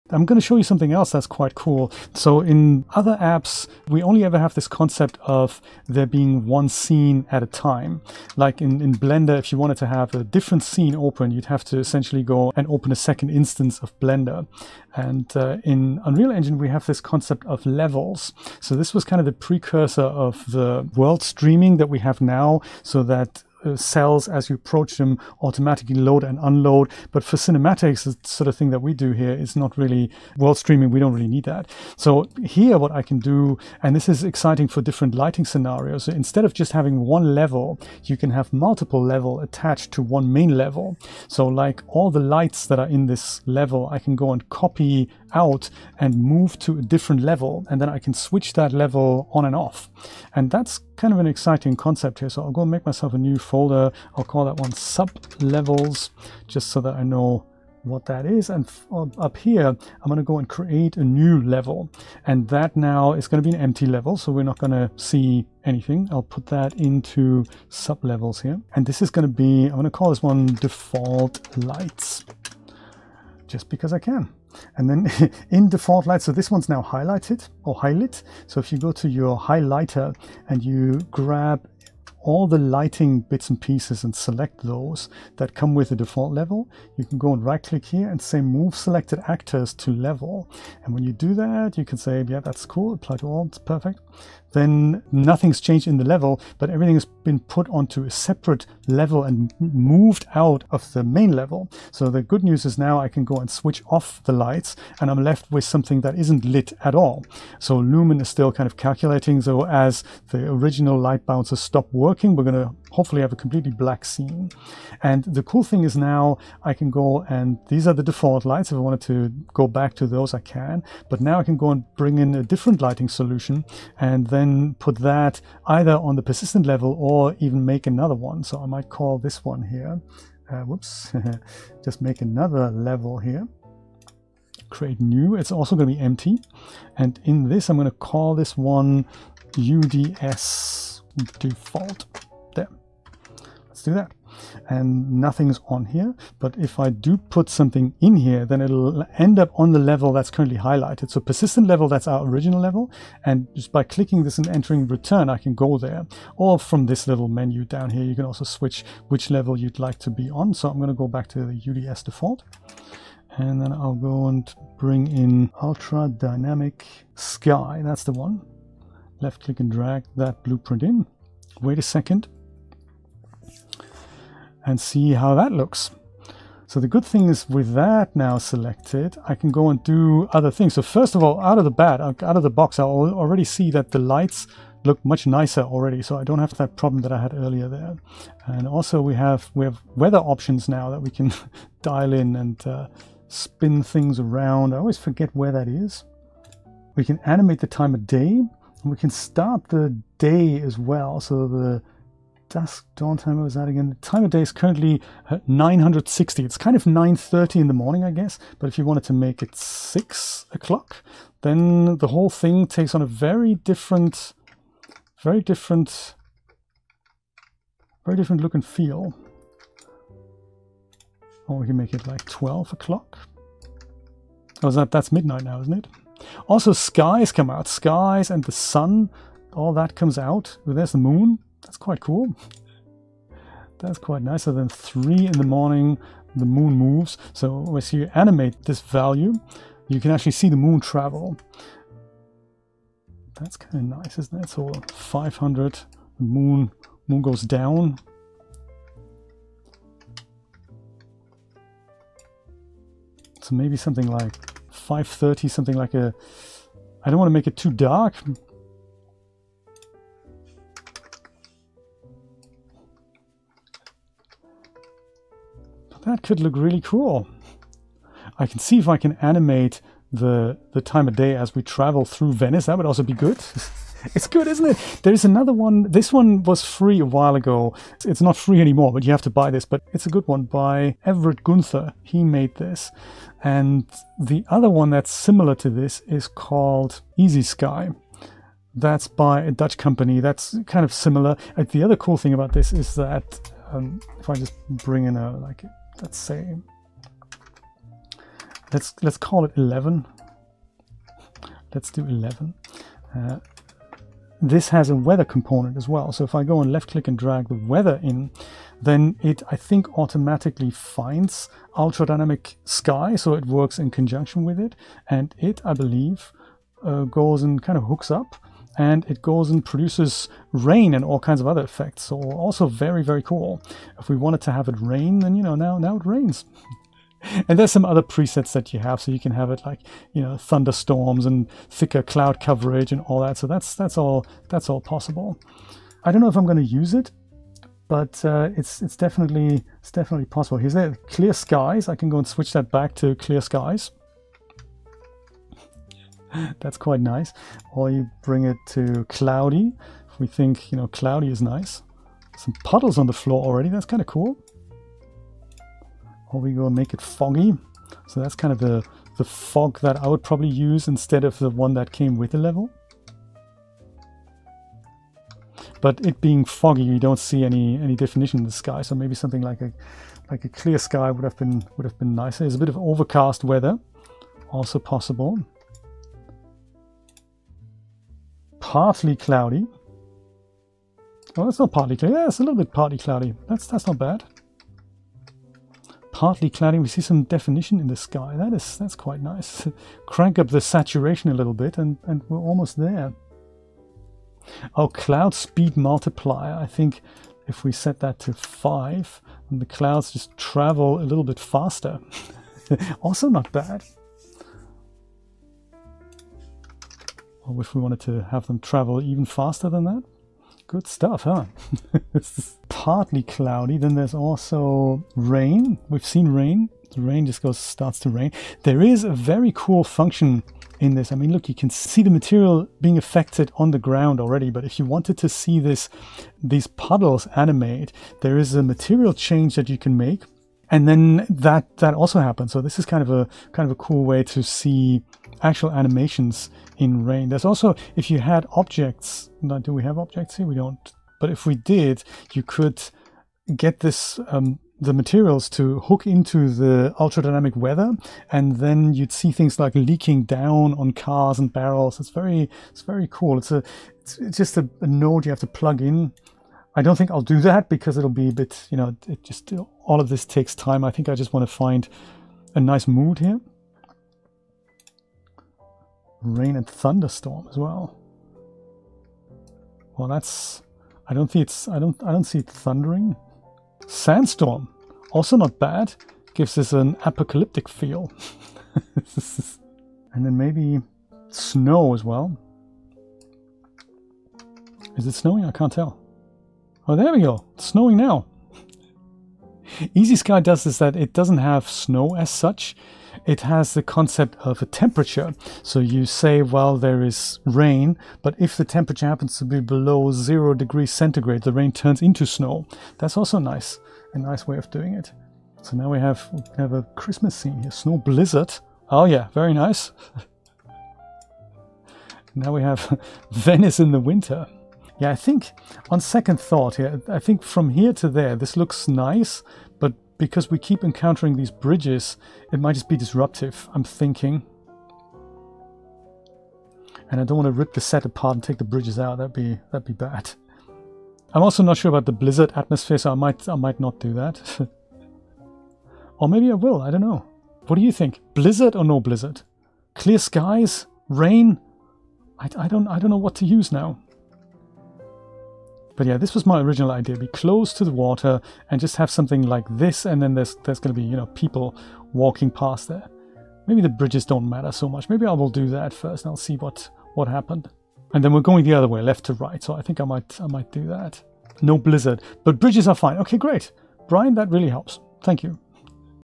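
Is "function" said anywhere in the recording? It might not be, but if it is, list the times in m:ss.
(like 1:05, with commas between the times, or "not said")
6:59.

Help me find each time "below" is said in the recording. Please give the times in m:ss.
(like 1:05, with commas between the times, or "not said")
8:19.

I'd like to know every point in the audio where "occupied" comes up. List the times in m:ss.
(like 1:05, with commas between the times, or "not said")
not said.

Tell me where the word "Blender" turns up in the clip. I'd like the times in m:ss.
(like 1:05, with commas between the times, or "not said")
0:08, 0:13.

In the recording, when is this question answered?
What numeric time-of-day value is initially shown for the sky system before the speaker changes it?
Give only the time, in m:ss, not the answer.
3:25.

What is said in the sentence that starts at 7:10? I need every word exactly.
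And then that, that also happens.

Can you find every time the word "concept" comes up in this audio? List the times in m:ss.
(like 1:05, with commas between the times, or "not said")
0:04, 0:16, 0:51, 8:13.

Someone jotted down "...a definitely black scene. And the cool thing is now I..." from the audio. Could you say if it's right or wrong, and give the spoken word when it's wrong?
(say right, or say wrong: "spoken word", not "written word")
wrong: "completely", not "definitely".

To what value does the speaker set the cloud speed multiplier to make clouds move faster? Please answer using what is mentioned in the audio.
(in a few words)
5.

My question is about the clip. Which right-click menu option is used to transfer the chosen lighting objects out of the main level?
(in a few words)
move selected actors to level.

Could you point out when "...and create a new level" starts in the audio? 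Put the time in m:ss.
1:00.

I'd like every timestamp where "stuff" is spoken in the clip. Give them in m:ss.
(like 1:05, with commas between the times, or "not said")
6:50.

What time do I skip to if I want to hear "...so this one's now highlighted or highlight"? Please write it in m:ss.
1:16.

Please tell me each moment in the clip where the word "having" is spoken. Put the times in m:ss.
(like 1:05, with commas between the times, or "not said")
0:36.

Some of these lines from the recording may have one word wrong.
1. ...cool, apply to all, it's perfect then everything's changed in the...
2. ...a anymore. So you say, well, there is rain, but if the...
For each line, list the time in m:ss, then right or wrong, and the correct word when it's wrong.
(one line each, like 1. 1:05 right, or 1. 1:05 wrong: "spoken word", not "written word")
1. 1:32 wrong: "nothing", not "everything"
2. 8:14 wrong: "temperature", not "anymore".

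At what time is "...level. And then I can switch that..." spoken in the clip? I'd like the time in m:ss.
0:47.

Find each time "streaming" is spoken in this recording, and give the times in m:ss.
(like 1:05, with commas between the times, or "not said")
0:21, 0:30.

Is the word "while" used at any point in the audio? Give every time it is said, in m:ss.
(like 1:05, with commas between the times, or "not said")
4:37.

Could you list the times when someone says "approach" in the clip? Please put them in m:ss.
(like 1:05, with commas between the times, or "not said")
0:24.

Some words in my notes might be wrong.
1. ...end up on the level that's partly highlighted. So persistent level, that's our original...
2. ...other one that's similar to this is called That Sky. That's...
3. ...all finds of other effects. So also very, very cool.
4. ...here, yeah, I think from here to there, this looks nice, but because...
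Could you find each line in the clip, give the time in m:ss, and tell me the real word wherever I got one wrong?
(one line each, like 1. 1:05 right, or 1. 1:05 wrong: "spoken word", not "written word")
1. 2:29 wrong: "currently", not "partly"
2. 4:44 wrong: "Easy", not "That"
3. 5:21 wrong: "kinds", not "finds"
4. 8:36 right.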